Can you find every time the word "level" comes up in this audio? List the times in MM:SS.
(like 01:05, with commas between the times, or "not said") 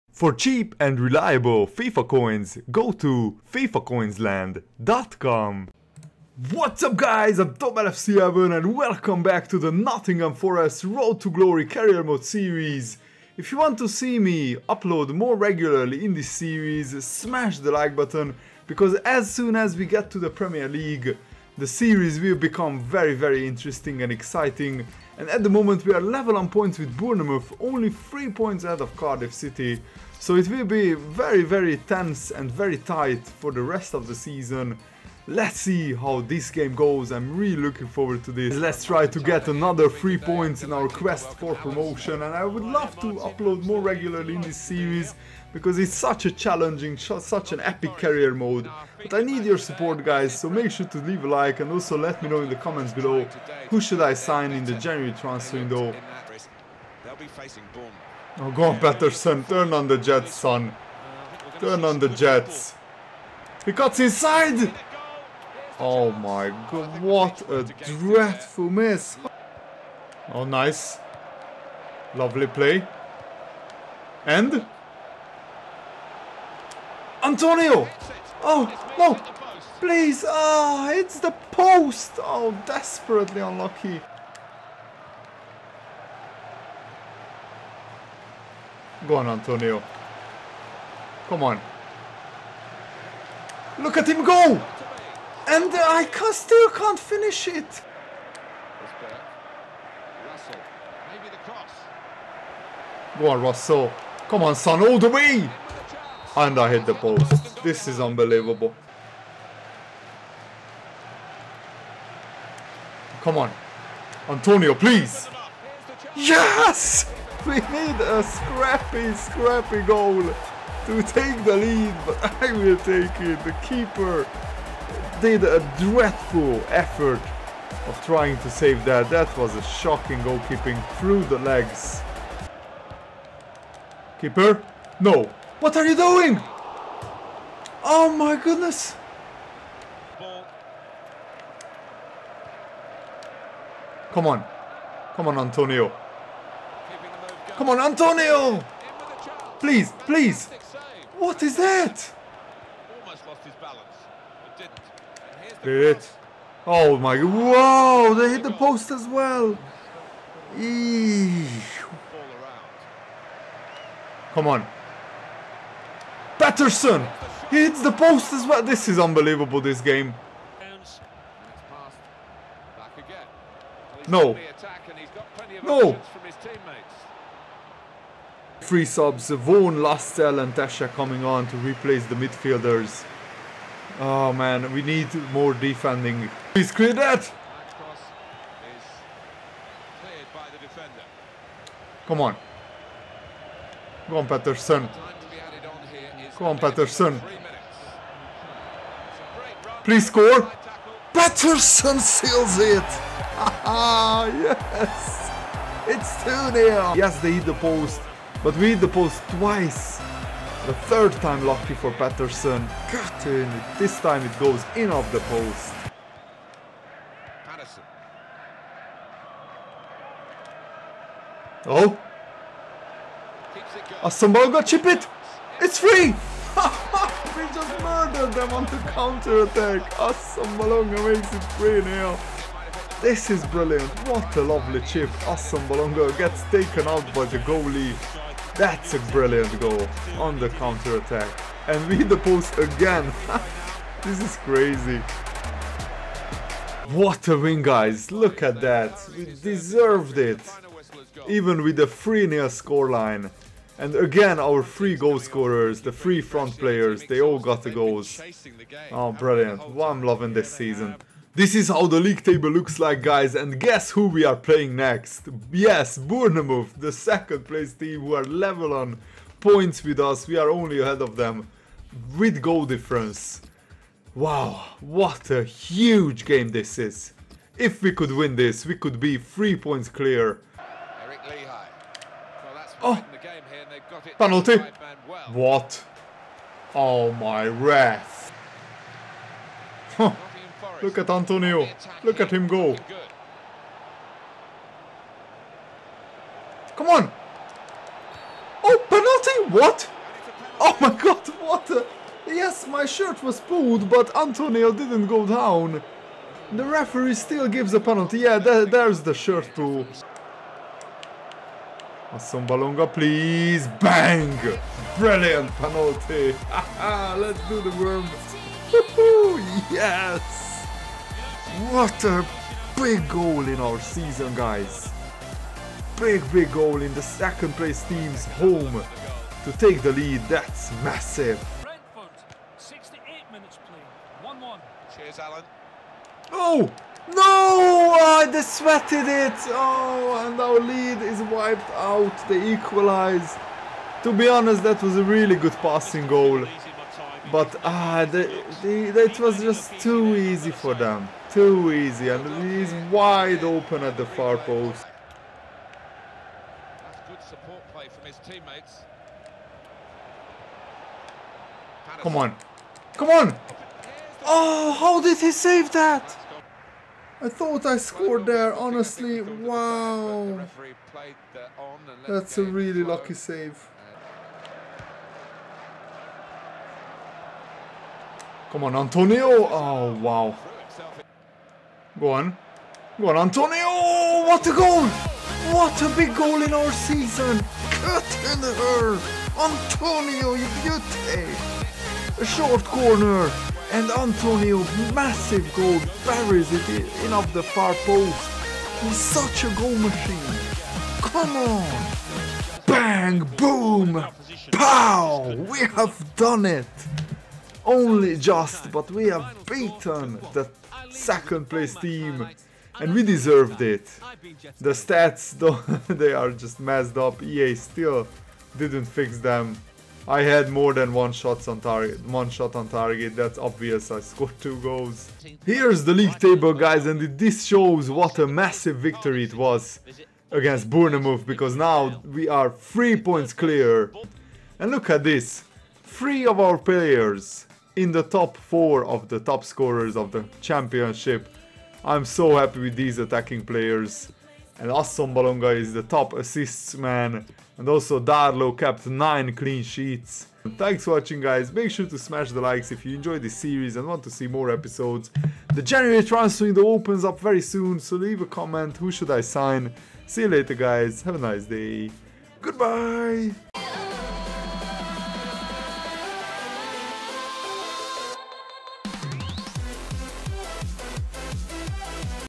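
00:26, 04:28.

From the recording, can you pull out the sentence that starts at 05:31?
Brentford, 68 minutes played, 1 1.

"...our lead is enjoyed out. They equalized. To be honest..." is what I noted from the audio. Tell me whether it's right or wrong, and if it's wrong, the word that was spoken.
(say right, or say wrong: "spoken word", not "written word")
wrong: "wiped", not "enjoyed".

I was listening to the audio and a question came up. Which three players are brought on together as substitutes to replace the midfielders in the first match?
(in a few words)
Vaughan, Lascelles and Tesche.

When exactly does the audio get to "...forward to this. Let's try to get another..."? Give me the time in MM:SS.
00:37.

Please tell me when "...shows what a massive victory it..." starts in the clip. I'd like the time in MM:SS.
07:07.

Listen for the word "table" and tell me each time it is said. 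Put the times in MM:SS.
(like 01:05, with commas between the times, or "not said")
04:22, 07:06.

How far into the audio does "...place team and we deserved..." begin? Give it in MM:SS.
06:51.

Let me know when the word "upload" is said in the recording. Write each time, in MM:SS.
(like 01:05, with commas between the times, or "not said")
00:14, 00:43.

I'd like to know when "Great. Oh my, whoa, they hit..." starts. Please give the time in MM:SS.
02:35.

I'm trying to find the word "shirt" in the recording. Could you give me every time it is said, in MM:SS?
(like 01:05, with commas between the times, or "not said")
05:02, 05:09.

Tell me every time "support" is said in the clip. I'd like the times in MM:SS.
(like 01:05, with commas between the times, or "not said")
00:49, 05:57.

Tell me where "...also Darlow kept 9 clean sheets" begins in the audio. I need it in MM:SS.
07:27.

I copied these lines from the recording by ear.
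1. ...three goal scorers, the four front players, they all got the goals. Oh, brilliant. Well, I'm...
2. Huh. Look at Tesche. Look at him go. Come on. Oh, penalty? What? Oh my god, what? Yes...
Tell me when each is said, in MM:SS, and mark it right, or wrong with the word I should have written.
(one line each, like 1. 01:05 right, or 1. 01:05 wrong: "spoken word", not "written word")
1. 04:14 wrong: "three", not "four"
2. 04:49 wrong: "Antonio", not "Tesche".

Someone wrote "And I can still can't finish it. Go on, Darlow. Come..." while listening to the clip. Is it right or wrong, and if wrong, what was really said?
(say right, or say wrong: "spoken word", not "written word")
wrong: "Russell", not "Darlow".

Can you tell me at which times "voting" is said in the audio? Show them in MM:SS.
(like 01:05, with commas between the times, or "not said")
not said.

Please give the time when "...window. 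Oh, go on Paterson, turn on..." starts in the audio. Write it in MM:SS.
00:55.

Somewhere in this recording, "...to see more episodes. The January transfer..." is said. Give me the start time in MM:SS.
07:34.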